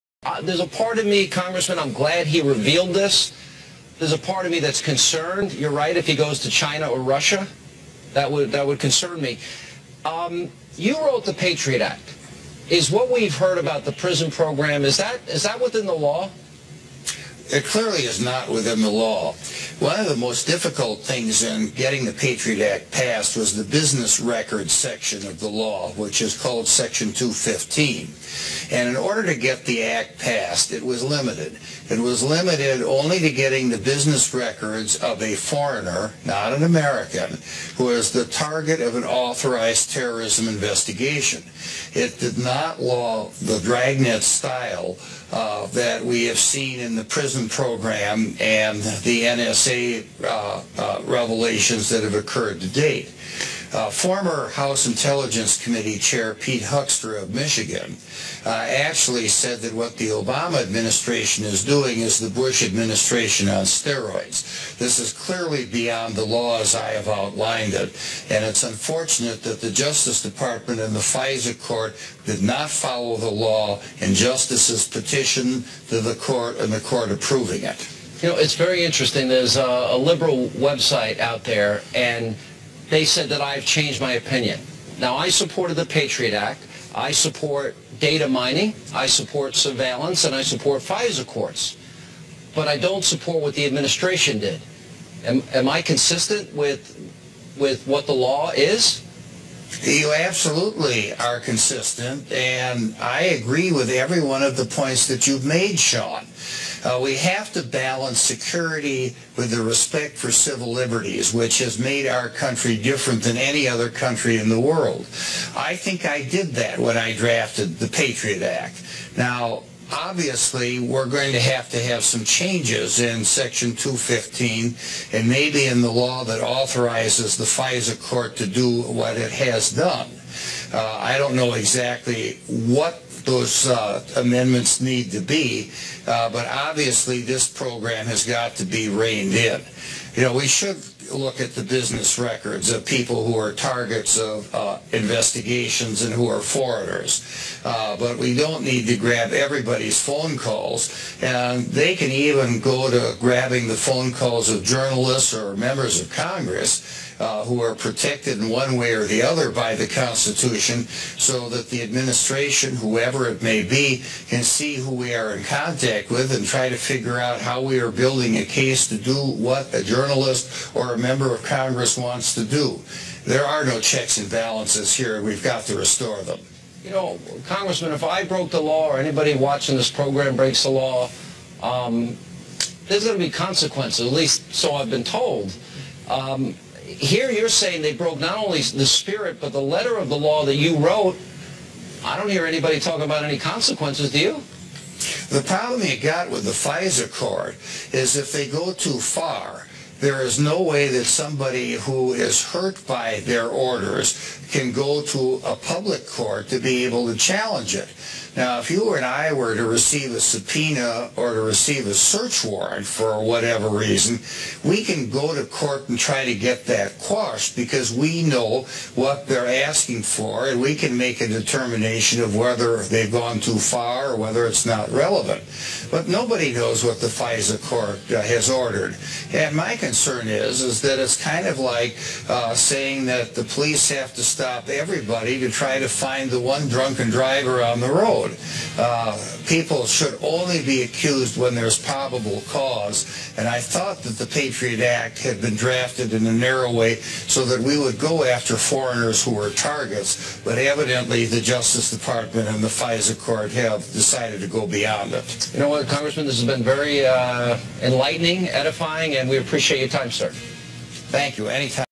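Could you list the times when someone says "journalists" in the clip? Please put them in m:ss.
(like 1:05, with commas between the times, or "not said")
2:34, 2:49.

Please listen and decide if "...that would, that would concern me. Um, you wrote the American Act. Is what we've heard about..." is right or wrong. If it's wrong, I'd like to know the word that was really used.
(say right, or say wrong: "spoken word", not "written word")
wrong: "Patriot", not "American".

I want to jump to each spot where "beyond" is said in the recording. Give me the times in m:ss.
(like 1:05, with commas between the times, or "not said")
1:05, 4:14.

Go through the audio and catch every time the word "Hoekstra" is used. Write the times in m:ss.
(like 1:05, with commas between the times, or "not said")
0:56.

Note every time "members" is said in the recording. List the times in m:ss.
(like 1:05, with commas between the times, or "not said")
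2:35, 2:51.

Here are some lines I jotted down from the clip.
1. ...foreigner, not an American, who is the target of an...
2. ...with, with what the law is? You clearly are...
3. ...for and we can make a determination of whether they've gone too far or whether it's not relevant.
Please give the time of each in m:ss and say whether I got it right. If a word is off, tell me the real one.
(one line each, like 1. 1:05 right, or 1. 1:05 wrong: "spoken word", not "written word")
1. 0:35 right
2. 1:36 wrong: "absolutely", not "clearly"
3. 3:40 right.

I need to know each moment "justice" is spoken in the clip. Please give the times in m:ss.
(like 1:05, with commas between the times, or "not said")
1:09, 1:14, 4:11.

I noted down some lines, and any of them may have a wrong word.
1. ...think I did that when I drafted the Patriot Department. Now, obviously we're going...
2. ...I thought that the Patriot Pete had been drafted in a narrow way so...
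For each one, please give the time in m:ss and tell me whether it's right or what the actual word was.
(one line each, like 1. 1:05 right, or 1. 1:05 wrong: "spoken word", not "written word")
1. 1:55 wrong: "Act", not "Department"
2. 4:03 wrong: "Act", not "Pete".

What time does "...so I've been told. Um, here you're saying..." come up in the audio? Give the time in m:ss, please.
3:04.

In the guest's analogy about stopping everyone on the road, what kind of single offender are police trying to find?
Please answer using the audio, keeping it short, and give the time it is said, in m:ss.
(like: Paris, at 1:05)
drunken driver, at 3:56.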